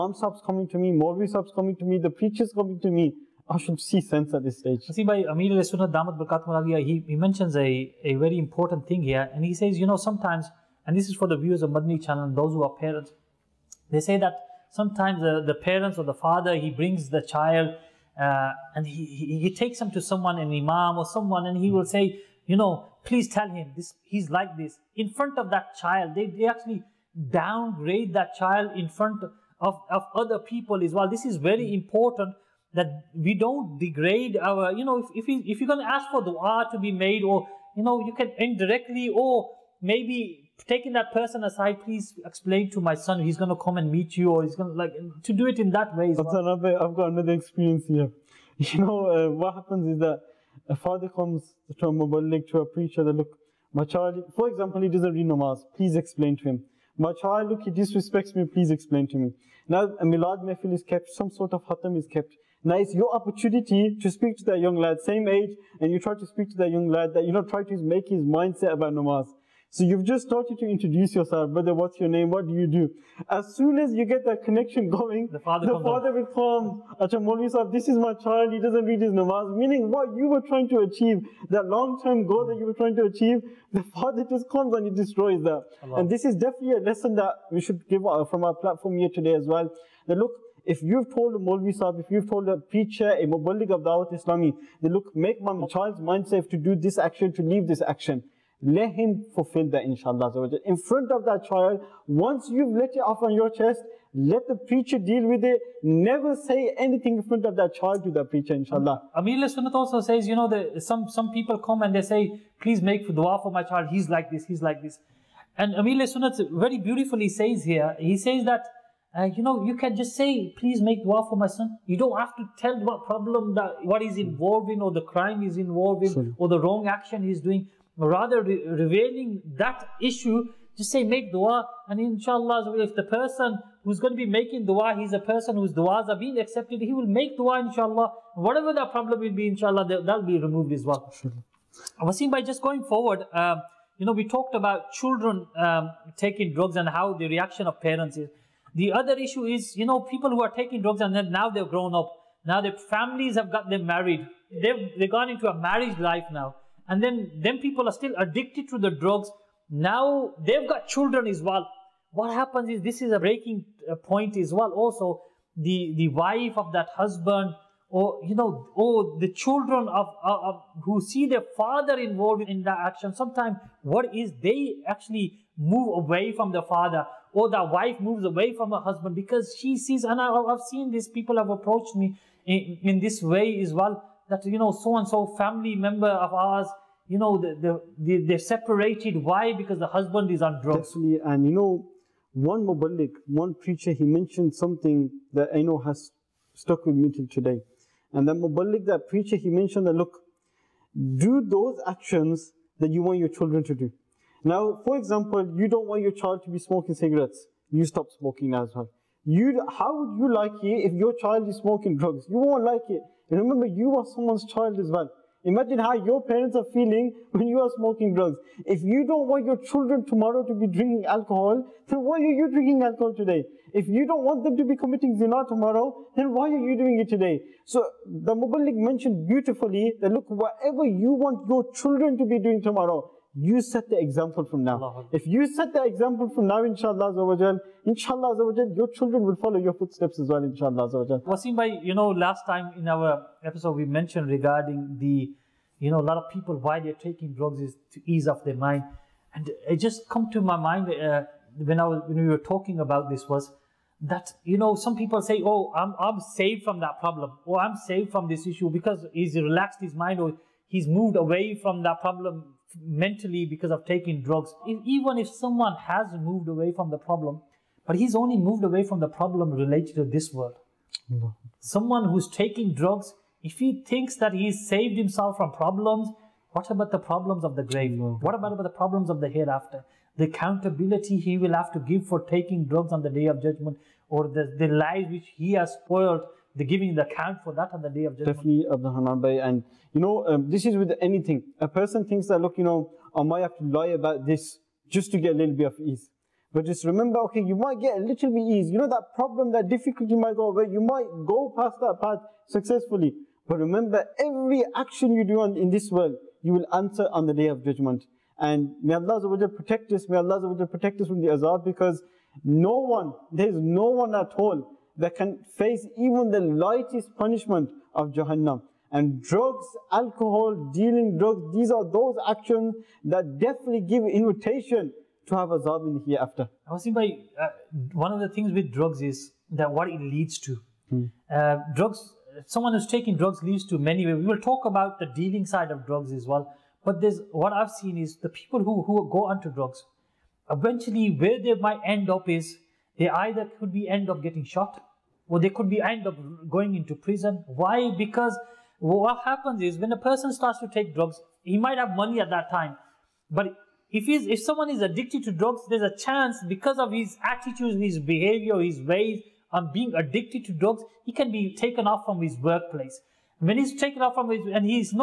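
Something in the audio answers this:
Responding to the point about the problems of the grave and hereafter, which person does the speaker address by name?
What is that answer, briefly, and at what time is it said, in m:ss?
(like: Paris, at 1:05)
Hanan Bhai, at 4:48.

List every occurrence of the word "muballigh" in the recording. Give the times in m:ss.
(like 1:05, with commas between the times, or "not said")
0:51, 1:33, 3:12, 3:18, 3:48.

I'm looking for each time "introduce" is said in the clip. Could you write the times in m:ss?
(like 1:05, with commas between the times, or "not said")
1:10.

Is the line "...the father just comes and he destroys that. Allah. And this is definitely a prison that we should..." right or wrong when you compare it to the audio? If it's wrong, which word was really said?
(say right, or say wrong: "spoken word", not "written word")
wrong: "lesson", not "prison".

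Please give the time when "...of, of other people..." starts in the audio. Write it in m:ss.
0:29.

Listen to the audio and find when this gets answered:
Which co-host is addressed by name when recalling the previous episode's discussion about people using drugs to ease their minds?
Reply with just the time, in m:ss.
4:01.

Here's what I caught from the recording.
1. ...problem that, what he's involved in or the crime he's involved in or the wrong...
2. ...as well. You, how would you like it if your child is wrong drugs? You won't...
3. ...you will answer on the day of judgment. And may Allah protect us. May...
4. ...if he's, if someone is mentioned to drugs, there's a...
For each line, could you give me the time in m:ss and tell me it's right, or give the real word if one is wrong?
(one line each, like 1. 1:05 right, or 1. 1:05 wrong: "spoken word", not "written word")
1. 2:03 right
2. 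3:28 wrong: "smoking", not "wrong"
3. 5:06 right
4. 5:53 wrong: "addicted", not "mentioned".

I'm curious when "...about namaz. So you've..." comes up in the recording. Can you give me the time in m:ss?
1:08.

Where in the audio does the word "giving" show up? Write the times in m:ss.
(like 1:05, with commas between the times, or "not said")
4:46.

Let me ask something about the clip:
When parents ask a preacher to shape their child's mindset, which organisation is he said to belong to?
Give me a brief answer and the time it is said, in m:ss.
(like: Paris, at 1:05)
Dawat Islami, at 1:33.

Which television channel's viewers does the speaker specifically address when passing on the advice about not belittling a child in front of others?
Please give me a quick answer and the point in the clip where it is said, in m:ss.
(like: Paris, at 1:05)
Madani channel, at 0:11.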